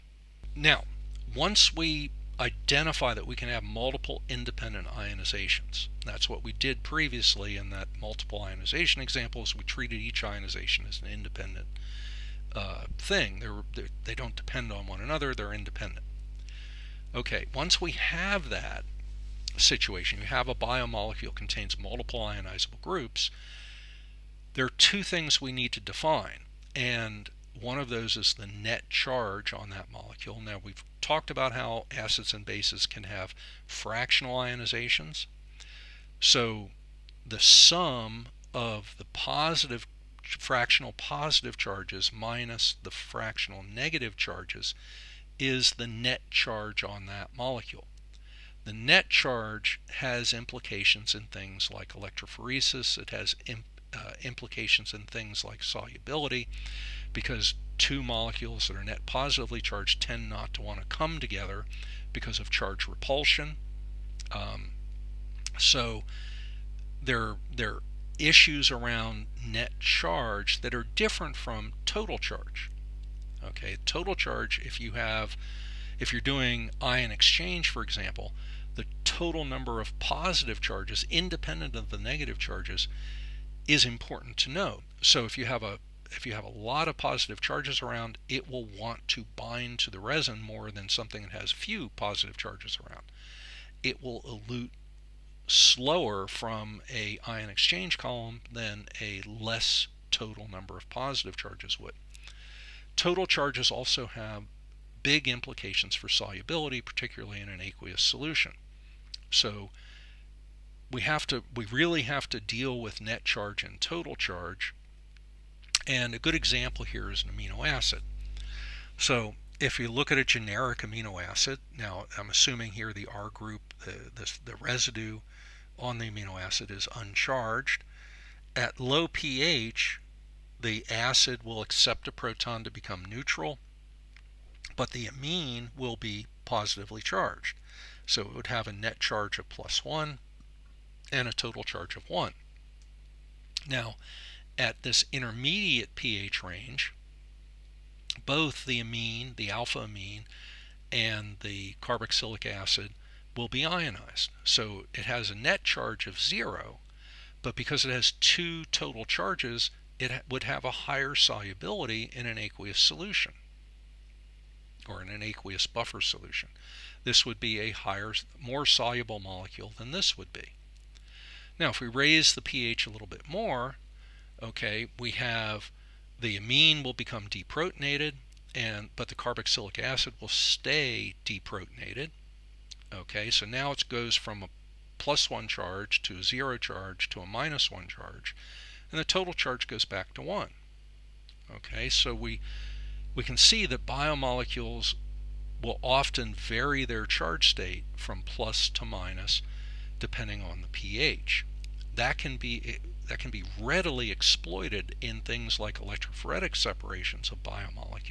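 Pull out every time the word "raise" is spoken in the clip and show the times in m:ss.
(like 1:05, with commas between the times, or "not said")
2:51.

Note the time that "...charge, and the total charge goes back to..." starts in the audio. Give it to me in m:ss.
3:07.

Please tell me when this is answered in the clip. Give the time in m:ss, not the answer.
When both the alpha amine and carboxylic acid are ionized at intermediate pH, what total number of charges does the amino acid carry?
2:38.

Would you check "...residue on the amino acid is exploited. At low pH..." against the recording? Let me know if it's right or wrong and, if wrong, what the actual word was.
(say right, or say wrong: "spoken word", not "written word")
wrong: "uncharged", not "exploited".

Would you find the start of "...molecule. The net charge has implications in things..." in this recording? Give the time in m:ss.
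0:47.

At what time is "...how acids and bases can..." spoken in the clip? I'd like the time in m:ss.
0:31.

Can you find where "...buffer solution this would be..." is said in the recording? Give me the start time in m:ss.
2:45.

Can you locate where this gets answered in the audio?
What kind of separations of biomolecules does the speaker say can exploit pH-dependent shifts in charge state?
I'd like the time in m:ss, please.
3:25.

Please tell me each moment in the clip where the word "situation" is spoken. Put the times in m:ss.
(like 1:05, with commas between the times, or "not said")
0:19.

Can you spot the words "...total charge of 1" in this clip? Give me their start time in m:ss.
2:21.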